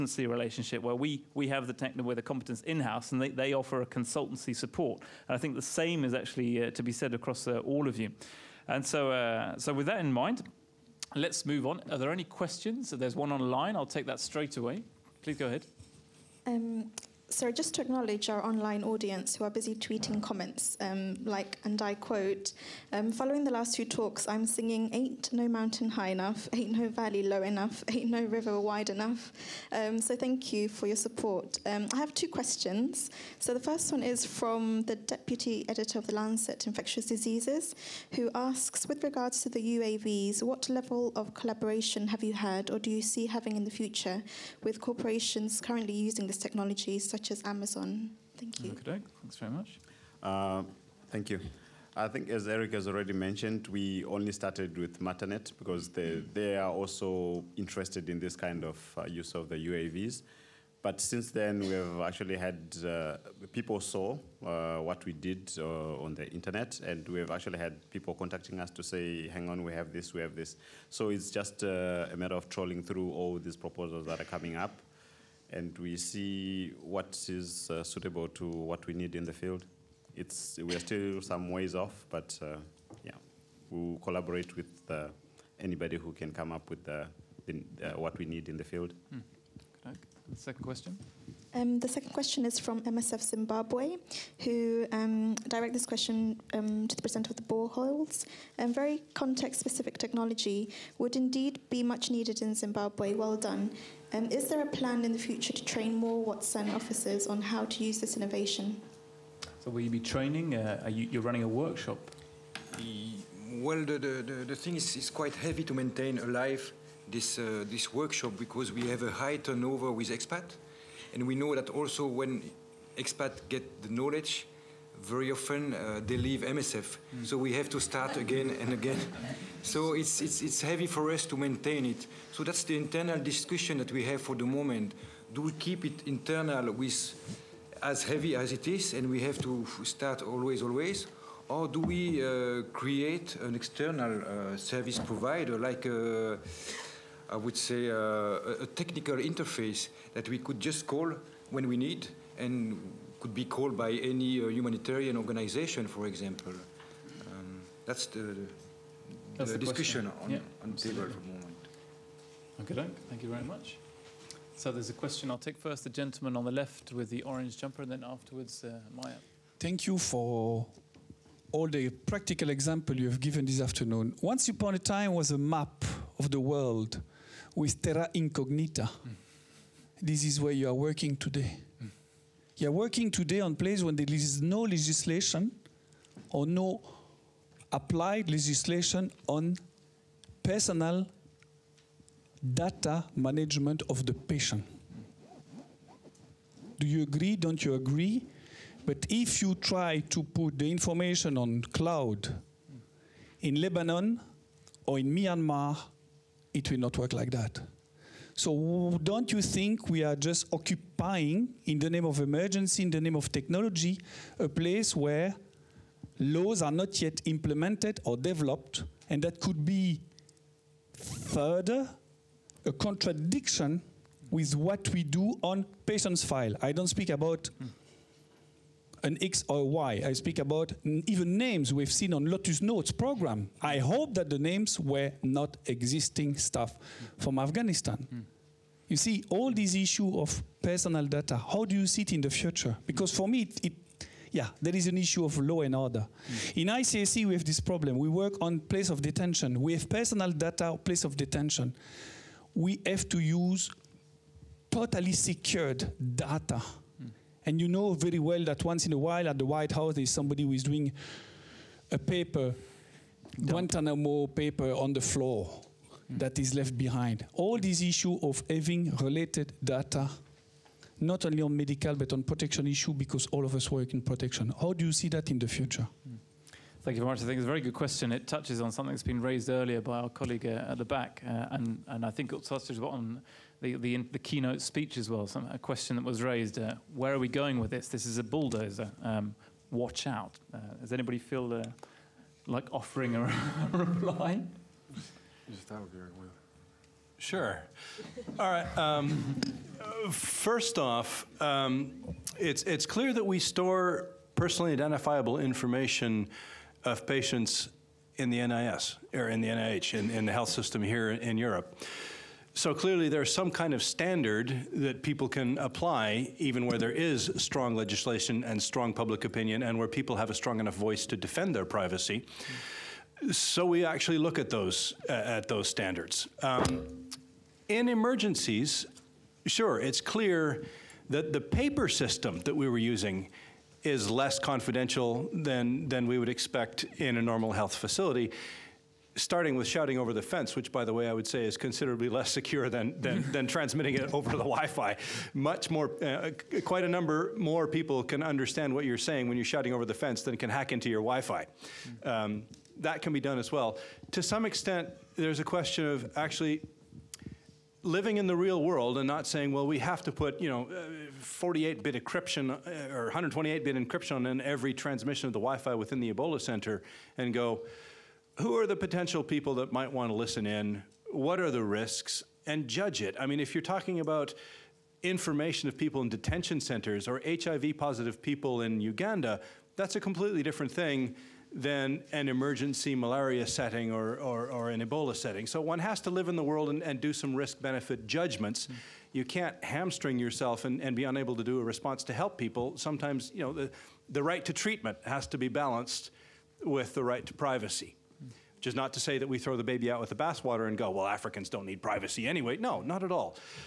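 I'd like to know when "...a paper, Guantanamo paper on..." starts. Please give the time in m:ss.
4:21.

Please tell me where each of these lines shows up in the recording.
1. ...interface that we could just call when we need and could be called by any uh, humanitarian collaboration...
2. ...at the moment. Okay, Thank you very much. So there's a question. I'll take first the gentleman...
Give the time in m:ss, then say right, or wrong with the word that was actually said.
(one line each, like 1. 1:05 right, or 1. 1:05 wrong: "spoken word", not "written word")
1. 2:29 wrong: "organization", not "collaboration"
2. 2:41 right.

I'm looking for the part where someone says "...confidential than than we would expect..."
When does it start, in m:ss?
5:34.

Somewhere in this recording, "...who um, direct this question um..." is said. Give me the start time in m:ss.
1:34.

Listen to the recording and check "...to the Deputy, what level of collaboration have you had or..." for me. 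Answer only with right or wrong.
wrong.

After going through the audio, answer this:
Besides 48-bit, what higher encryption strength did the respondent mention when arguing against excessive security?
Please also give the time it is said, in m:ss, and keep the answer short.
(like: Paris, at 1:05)
128-bit, at 6:03.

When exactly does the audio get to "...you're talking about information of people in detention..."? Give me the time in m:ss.
6:13.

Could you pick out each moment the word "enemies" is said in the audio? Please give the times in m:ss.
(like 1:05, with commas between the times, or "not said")
not said.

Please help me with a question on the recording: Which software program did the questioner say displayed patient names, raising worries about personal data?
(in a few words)
Lotus Notes.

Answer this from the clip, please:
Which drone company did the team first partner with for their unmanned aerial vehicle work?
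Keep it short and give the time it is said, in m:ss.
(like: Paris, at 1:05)
Matternet, at 0:54.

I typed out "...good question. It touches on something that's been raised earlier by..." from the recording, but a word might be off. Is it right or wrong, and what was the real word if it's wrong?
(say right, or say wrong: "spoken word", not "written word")
right.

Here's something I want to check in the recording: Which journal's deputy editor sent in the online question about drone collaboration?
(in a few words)
Lancet Infectious Diseases.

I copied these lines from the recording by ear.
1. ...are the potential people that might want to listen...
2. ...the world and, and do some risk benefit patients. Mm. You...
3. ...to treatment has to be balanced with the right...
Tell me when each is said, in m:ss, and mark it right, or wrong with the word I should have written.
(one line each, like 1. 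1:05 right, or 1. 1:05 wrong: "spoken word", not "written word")
1. 6:08 right
2. 6:26 wrong: "judgments", not "patients"
3. 6:34 right.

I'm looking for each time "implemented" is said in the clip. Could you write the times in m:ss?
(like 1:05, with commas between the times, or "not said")
3:37.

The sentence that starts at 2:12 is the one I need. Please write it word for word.
So that's the internal discussion that we have for the moment.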